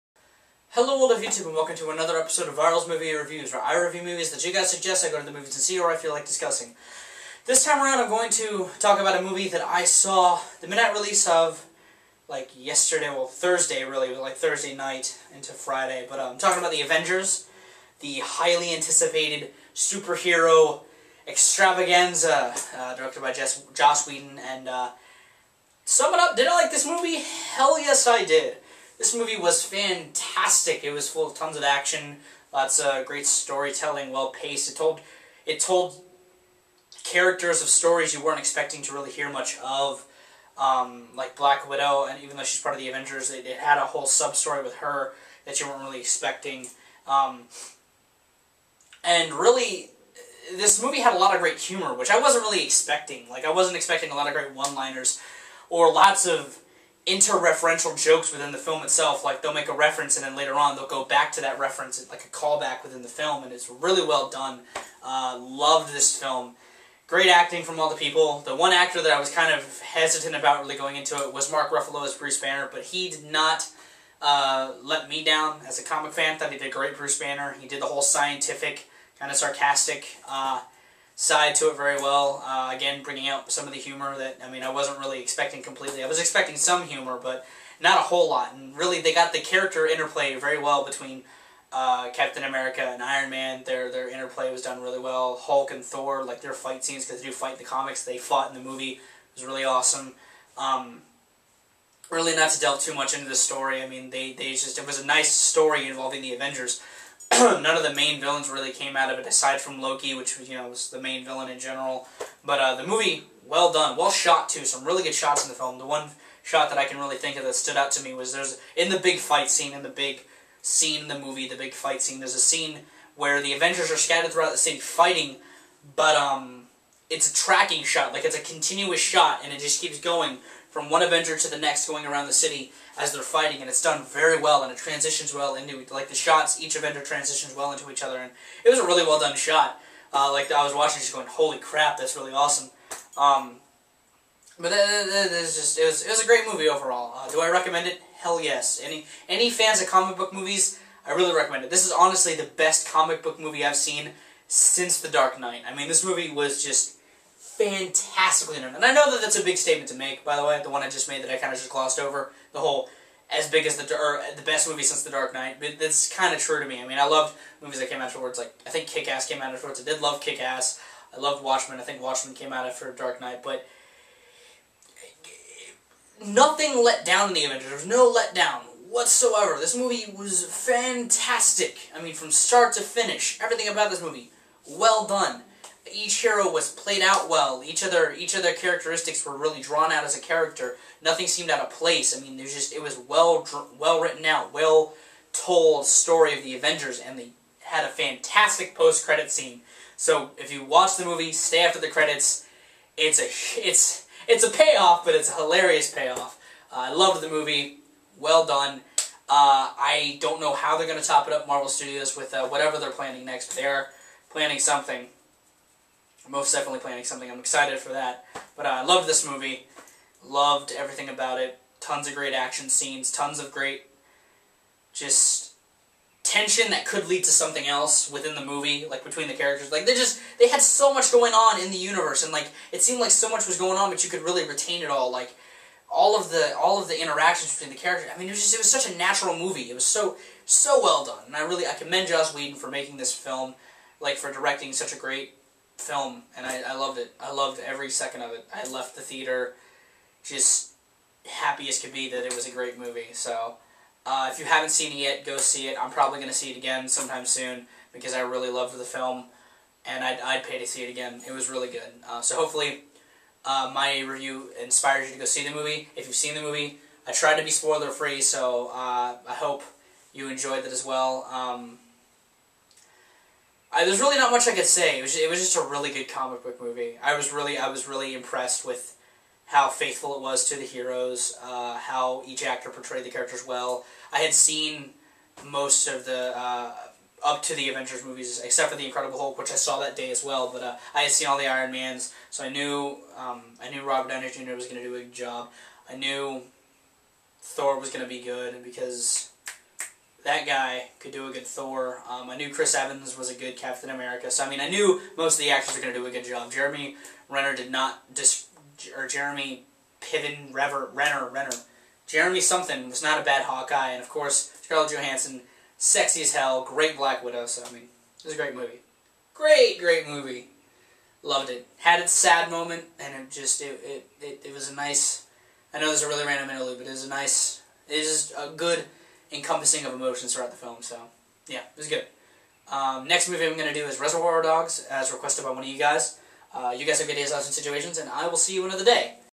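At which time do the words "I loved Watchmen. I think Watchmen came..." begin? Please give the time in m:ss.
2:51.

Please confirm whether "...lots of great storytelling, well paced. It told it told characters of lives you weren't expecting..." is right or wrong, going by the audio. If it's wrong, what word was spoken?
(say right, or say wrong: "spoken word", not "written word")
wrong: "stories", not "lives".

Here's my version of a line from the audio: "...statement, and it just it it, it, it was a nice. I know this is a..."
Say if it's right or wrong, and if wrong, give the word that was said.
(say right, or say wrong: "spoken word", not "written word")
wrong: "moment", not "statement".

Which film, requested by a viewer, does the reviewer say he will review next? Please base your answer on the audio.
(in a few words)
Reservoir Dogs.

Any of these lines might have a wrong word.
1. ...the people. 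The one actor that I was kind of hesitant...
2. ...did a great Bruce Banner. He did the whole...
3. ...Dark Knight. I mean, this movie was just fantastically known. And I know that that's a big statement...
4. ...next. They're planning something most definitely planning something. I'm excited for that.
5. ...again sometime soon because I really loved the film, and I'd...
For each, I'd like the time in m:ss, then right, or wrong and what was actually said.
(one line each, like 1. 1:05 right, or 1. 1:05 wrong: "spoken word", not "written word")
1. 1:07 right
2. 1:16 right
3. 2:35 right
4. 3:33 right
5. 4:16 right.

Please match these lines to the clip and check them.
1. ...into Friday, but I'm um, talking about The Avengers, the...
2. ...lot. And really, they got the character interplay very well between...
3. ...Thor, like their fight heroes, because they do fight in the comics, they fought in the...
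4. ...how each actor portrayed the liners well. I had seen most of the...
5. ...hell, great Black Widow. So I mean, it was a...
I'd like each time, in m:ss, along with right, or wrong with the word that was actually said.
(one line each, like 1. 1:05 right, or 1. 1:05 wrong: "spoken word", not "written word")
1. 0:15 right
2. 1:28 right
3. 1:35 wrong: "scenes", not "heroes"
4. 4:41 wrong: "characters", not "liners"
5. 5:16 right.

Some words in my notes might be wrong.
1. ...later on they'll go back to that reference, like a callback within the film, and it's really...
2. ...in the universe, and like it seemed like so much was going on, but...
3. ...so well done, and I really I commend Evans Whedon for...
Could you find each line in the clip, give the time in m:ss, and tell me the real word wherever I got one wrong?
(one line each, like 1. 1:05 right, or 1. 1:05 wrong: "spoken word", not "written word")
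1. 1:00 right
2. 3:51 right
3. 4:00 wrong: "Joss", not "Evans".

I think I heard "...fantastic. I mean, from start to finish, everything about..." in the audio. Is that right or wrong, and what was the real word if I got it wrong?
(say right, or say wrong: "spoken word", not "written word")
right.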